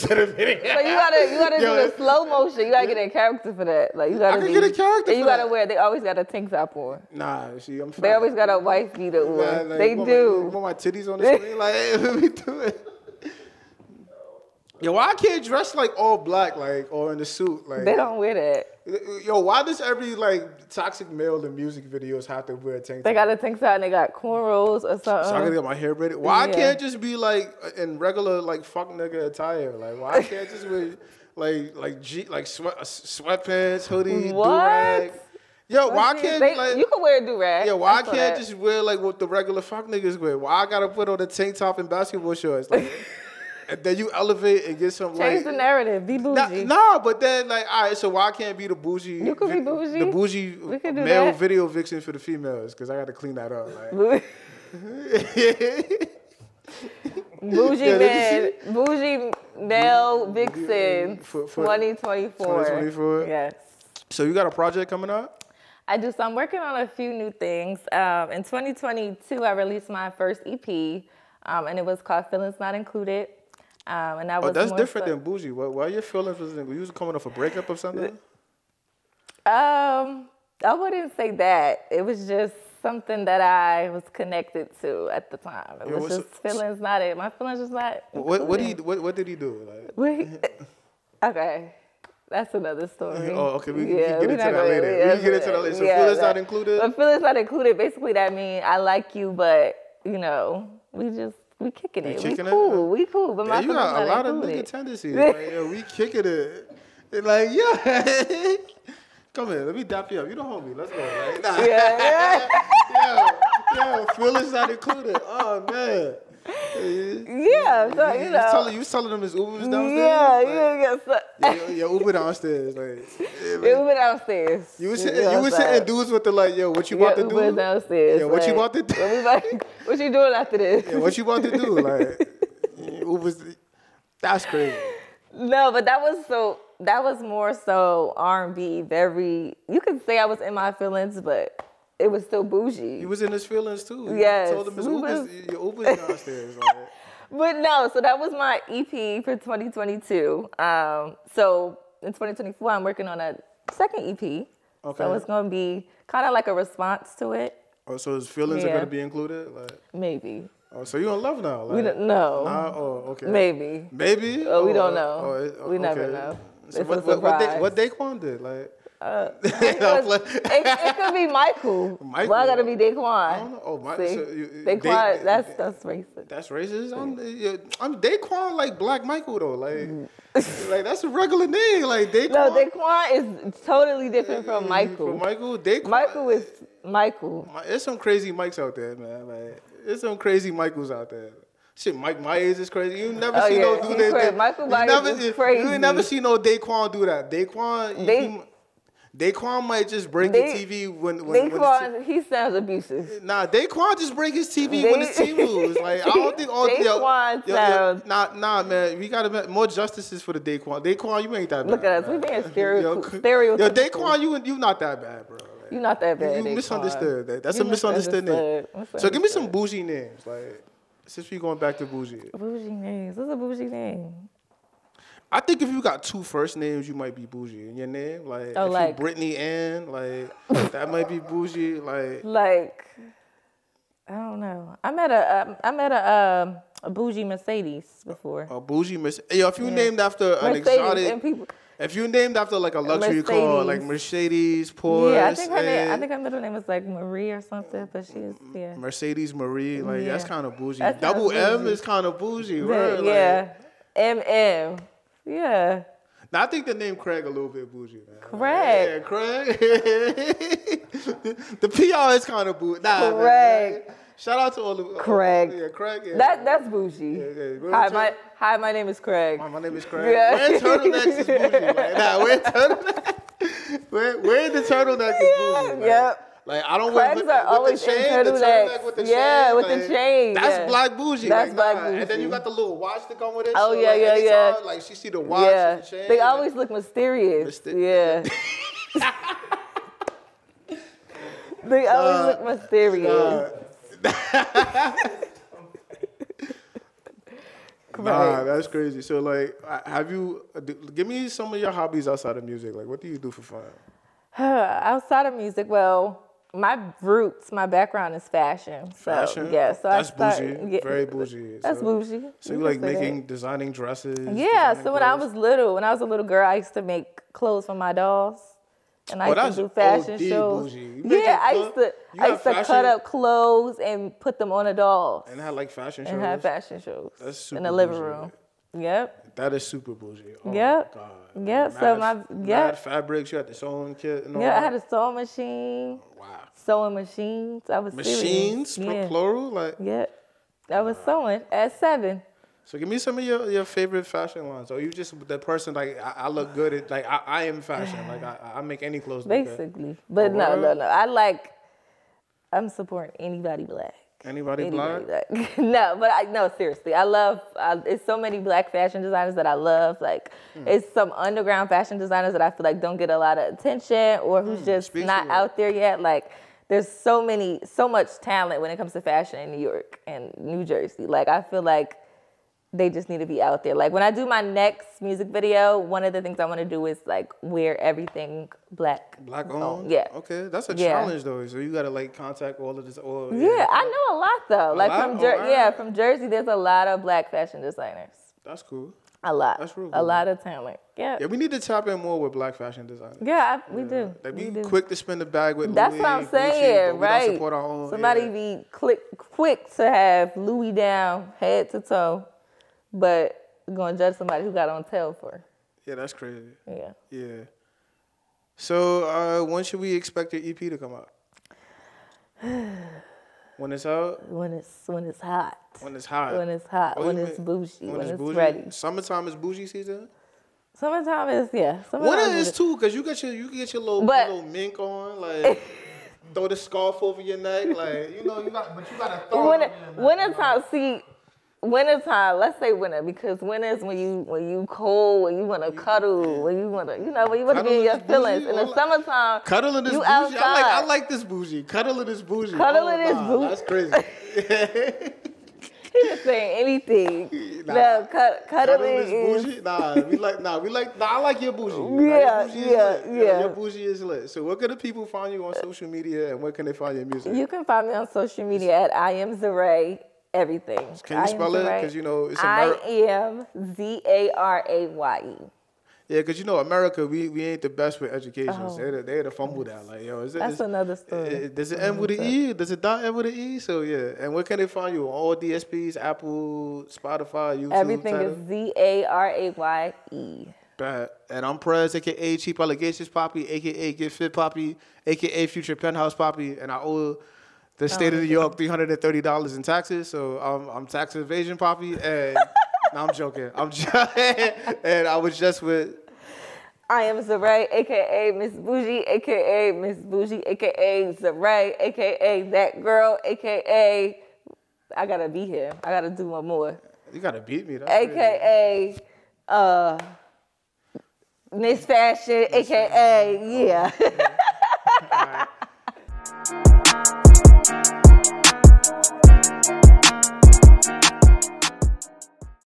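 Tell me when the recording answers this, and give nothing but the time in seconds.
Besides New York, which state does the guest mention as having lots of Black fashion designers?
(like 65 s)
370 s.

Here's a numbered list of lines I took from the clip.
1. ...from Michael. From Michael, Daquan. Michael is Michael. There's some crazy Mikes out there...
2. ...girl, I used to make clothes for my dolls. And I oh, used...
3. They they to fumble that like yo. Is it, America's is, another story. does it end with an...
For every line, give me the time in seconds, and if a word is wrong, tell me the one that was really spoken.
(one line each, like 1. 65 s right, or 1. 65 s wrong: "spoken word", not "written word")
1. 184 s right
2. 316 s right
3. 468 s wrong: "That", not "America".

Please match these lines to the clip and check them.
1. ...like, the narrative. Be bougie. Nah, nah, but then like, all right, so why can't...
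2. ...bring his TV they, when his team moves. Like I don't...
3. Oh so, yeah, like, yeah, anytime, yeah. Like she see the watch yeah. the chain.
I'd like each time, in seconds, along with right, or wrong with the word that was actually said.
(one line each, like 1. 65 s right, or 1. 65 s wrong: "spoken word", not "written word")
1. 45 s right
2. 204 s right
3. 283 s right.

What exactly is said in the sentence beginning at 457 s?
You can find me on social media at I am Zaraye everything.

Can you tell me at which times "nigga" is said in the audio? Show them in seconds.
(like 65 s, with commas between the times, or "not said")
28 s, 39 s, 104 s.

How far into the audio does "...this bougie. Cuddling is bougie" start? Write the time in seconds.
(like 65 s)
441 s.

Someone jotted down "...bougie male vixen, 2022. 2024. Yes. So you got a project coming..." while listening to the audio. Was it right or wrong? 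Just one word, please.
wrong.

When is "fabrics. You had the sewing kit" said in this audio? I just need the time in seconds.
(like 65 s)
332 s.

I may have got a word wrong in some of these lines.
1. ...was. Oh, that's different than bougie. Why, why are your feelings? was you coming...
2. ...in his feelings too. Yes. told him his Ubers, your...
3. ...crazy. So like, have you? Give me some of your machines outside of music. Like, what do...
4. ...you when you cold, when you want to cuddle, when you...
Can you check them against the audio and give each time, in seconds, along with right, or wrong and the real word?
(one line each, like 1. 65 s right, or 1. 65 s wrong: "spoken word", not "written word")
1. 74 s right
2. 143 s right
3. 298 s wrong: "hobbies", not "machines"
4. 433 s right.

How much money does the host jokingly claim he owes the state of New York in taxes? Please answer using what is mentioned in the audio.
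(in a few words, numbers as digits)
$330.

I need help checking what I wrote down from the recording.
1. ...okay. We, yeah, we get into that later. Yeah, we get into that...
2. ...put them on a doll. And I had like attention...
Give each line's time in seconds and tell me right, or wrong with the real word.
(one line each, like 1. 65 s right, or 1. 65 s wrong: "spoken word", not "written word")
1. 93 s right
2. 324 s wrong: "fashion", not "attention".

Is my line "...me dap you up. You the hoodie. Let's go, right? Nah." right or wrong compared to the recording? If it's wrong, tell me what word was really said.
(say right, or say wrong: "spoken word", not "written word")
wrong: "homie", not "hoodie".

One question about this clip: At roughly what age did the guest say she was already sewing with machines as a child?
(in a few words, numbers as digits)
7.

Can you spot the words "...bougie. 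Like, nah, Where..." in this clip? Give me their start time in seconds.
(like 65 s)
271 s.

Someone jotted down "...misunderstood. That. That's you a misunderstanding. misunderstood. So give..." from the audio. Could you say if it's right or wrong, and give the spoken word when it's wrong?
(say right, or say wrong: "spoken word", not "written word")
right.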